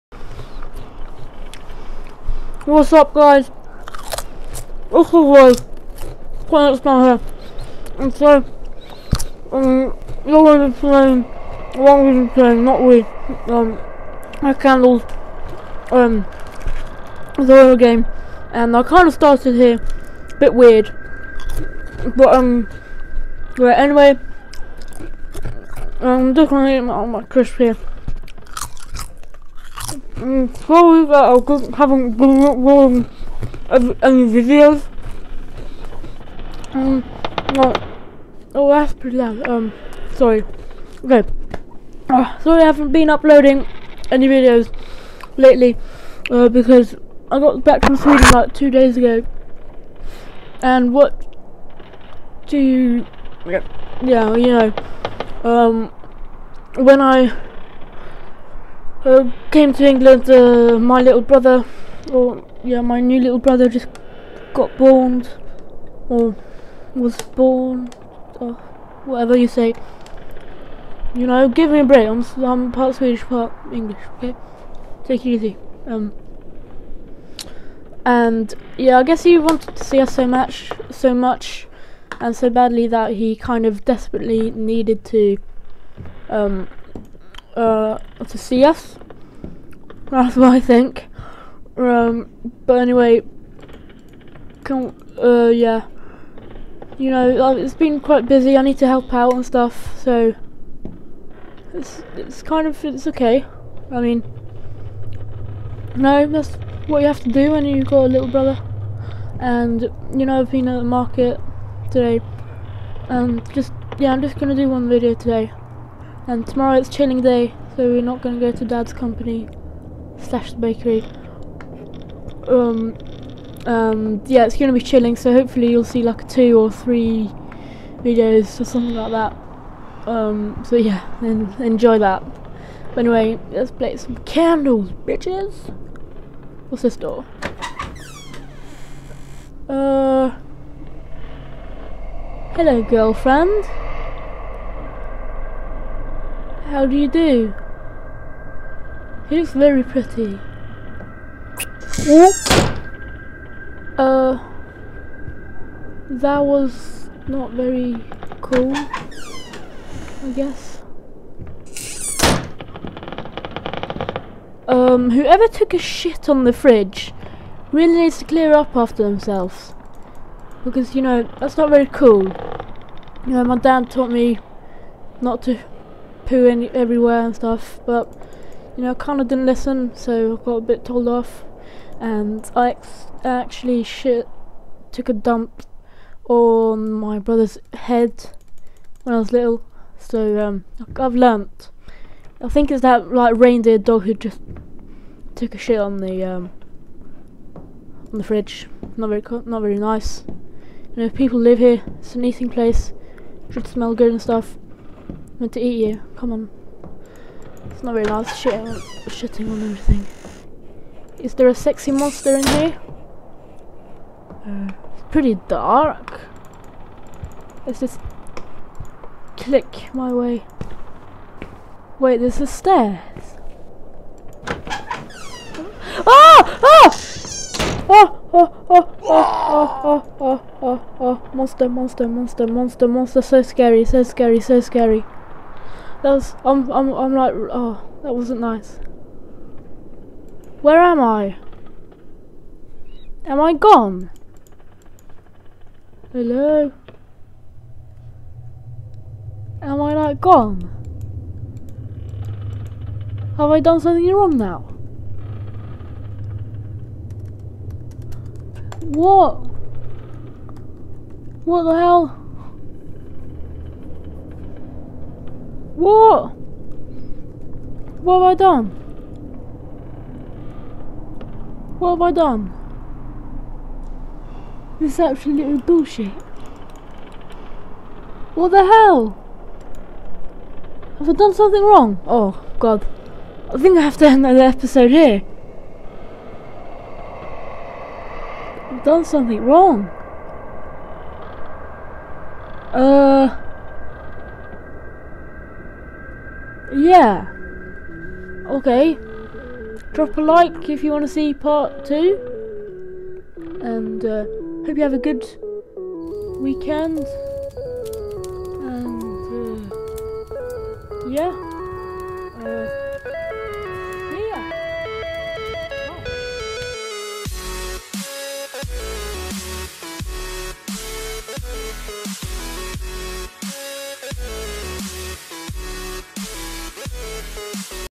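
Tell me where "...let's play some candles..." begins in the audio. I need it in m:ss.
2:13.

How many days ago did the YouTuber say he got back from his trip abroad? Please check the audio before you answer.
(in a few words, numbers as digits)
2.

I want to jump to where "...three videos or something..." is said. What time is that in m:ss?
2:06.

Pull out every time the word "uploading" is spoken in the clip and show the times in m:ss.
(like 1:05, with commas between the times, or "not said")
0:32, 0:43.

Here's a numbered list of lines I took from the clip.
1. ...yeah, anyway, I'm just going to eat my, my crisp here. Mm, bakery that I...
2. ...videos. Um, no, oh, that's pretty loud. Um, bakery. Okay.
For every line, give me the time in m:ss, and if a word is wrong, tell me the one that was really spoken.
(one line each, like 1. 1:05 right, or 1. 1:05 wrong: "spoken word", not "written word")
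1. 0:23 wrong: "sorry", not "bakery"
2. 0:34 wrong: "sorry", not "bakery".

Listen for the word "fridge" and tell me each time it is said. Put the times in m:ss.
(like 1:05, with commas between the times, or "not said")
2:46, 3:18.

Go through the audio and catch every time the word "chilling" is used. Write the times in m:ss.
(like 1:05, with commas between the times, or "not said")
1:56, 2:04.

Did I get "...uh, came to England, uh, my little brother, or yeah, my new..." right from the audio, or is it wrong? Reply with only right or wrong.
right.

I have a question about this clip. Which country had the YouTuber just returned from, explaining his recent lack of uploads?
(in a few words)
Sweden.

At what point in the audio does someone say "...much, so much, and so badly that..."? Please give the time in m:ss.
1:20.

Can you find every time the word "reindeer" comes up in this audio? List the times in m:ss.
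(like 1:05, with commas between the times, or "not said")
3:13.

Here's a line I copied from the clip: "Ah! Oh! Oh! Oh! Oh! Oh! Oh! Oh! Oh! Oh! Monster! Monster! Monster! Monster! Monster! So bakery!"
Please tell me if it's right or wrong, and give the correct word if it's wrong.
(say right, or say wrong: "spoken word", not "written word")
wrong: "scary", not "bakery".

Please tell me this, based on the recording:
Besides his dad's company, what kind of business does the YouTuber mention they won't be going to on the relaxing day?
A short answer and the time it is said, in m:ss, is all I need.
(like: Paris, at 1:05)
bakery, at 2:00.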